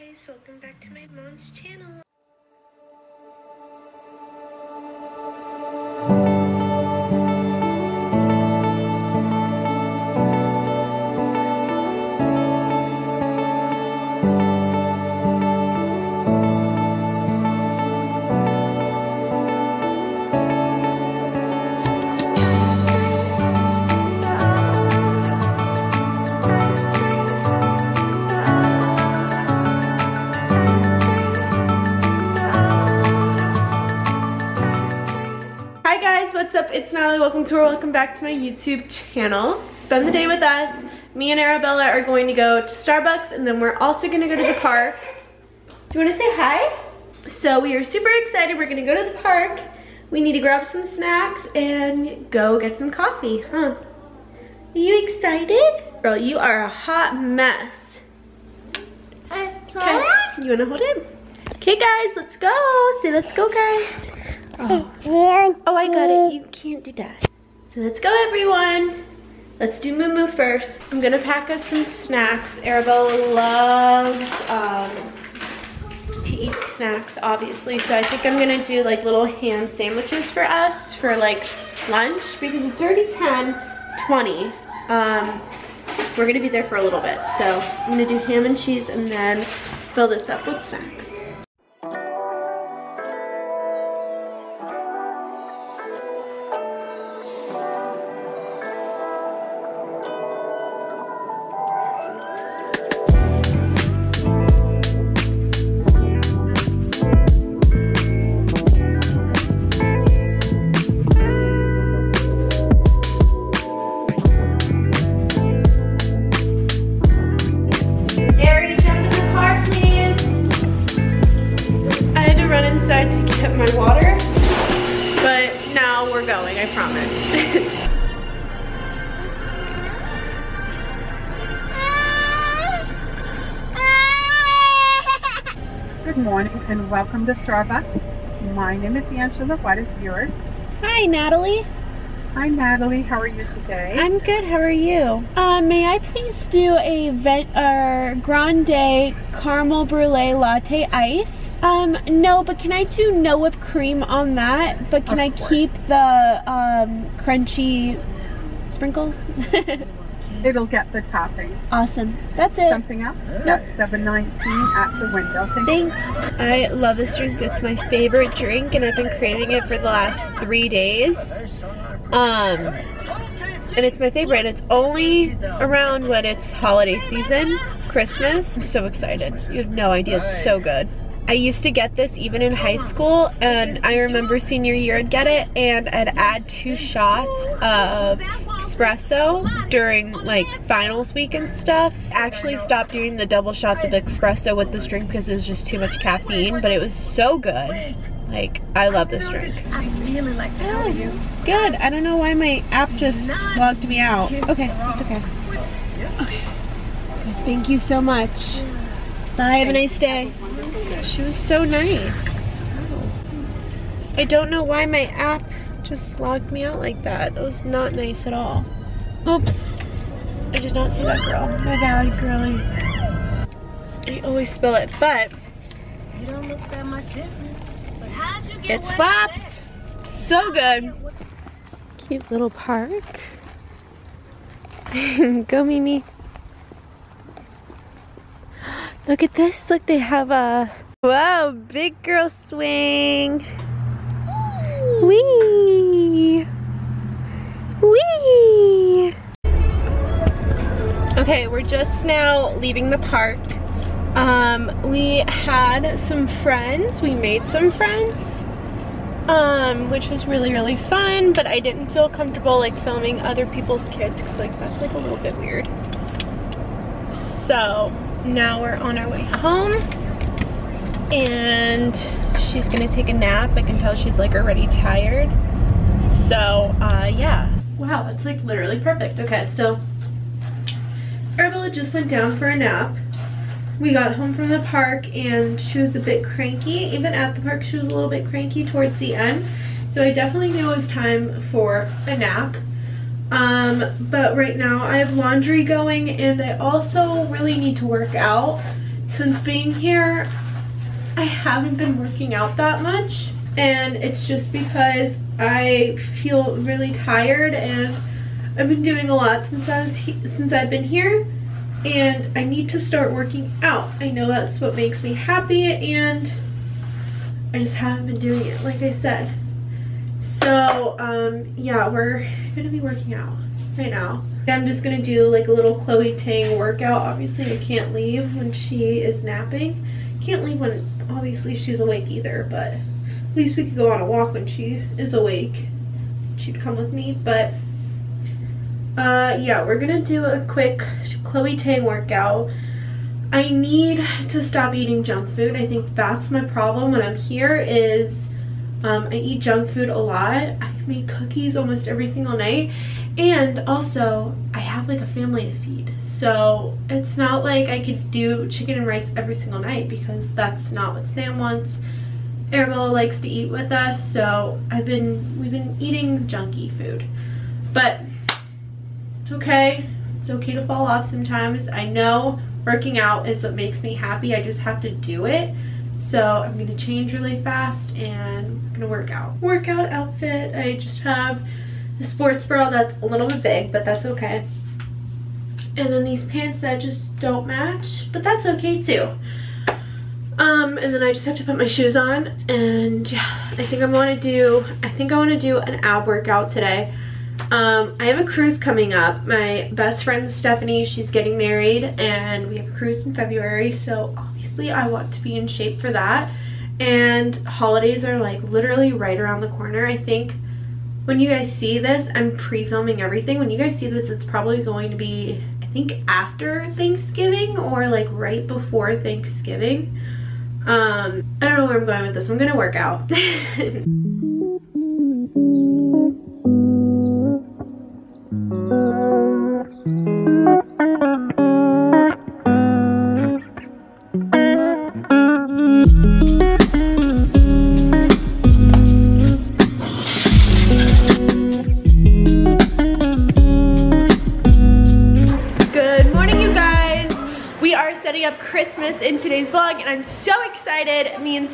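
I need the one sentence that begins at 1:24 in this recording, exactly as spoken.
Um, we're gonna be there for a little bit.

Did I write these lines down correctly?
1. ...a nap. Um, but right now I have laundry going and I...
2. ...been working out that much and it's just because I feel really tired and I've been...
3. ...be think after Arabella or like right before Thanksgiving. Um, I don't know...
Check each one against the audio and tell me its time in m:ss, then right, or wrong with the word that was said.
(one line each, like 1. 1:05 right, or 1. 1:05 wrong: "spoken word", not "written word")
1. 4:52 right
2. 5:01 right
3. 6:54 wrong: "Thanksgiving", not "Arabella".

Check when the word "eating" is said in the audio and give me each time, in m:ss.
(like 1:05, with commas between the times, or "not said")
5:44, 6:05.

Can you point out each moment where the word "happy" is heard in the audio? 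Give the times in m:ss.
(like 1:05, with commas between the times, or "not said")
5:15, 6:13.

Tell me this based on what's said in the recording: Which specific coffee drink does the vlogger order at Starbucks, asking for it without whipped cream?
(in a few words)
caramel brulee latte.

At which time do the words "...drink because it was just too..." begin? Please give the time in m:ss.
3:14.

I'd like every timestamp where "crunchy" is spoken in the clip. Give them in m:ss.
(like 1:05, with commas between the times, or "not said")
2:37.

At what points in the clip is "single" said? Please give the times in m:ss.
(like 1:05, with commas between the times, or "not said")
5:52, 5:59.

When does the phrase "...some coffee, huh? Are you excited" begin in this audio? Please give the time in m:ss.
0:52.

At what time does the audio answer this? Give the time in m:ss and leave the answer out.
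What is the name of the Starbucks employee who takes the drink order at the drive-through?
2:19.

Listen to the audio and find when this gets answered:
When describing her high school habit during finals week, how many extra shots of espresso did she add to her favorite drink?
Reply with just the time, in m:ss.
3:06.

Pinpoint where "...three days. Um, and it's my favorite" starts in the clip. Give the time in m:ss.
2:50.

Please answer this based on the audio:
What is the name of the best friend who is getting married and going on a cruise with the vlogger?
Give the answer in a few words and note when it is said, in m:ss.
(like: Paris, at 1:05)
Stephanie, at 6:40.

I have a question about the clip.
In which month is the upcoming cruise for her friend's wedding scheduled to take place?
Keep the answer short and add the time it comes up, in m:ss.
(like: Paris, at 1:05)
February, at 6:43.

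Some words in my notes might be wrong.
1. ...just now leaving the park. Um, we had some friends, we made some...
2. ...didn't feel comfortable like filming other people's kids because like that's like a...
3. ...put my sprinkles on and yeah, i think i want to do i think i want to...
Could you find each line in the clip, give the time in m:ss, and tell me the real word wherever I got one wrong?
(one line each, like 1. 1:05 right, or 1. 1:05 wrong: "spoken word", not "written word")
1. 4:11 right
2. 4:21 right
3. 6:31 wrong: "shoes", not "sprinkles".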